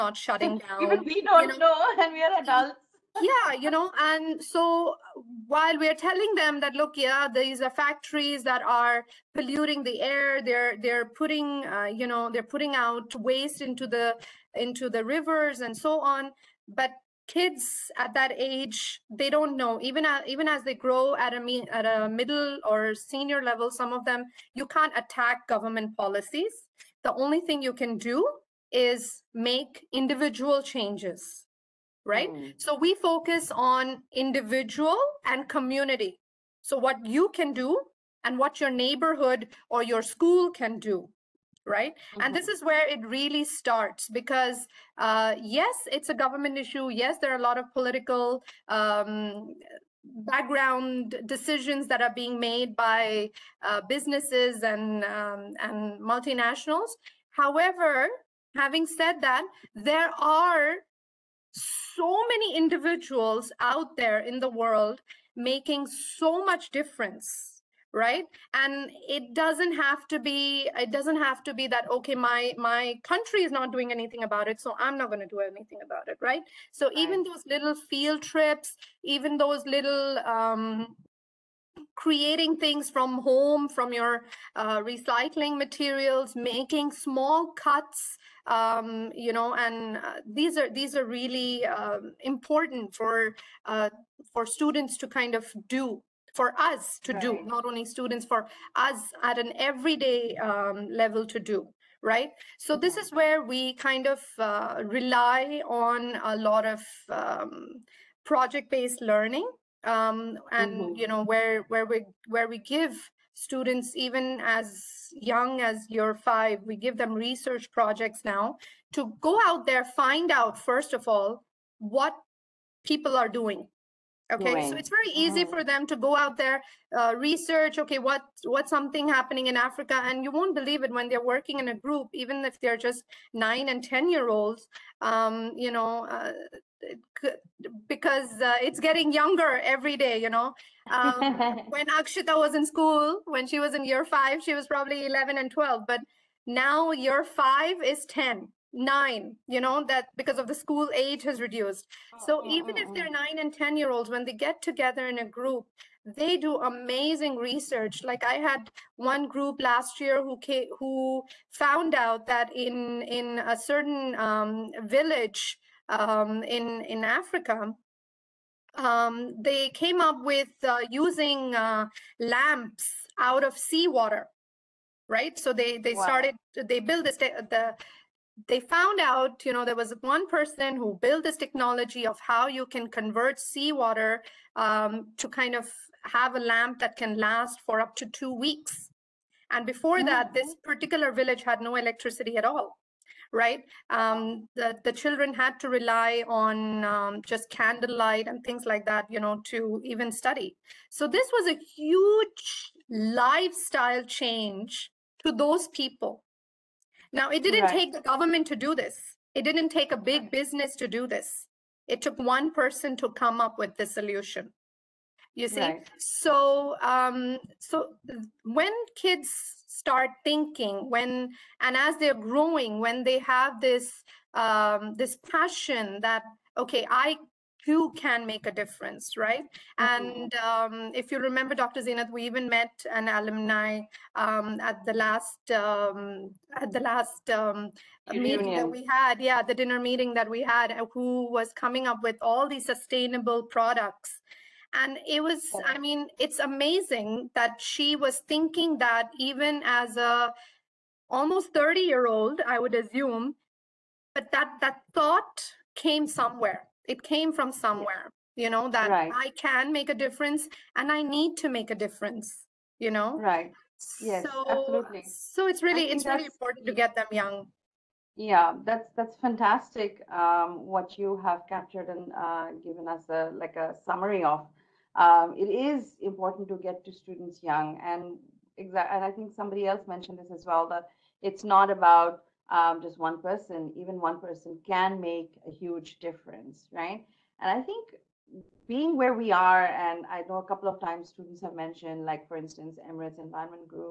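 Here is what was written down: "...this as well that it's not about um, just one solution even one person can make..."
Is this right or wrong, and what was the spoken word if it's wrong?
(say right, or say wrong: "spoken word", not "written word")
wrong: "person", not "solution".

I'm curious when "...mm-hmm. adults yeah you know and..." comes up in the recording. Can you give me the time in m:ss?
0:02.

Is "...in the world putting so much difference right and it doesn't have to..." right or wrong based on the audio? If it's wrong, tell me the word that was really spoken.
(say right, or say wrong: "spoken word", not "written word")
wrong: "making", not "putting".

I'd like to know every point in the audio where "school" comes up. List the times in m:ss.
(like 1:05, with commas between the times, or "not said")
0:40, 2:22, 2:30.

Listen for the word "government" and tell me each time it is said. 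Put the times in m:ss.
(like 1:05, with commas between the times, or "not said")
0:25, 0:46, 3:27.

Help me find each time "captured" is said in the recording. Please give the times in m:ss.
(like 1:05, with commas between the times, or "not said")
4:31.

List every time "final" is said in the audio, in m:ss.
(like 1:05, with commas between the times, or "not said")
not said.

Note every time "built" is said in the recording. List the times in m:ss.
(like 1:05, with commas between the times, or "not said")
2:56, 3:00.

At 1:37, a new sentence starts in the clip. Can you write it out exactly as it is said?
do, not only students, for us at an everyday um, level to do right?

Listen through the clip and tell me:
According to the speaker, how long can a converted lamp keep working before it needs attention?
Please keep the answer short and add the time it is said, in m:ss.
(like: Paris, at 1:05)
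2 weeks, at 3:08.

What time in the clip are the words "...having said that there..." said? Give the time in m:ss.
0:58.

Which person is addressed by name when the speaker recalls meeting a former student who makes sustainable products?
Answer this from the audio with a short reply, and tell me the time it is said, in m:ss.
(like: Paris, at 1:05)
Dr Zeenath, at 3:51.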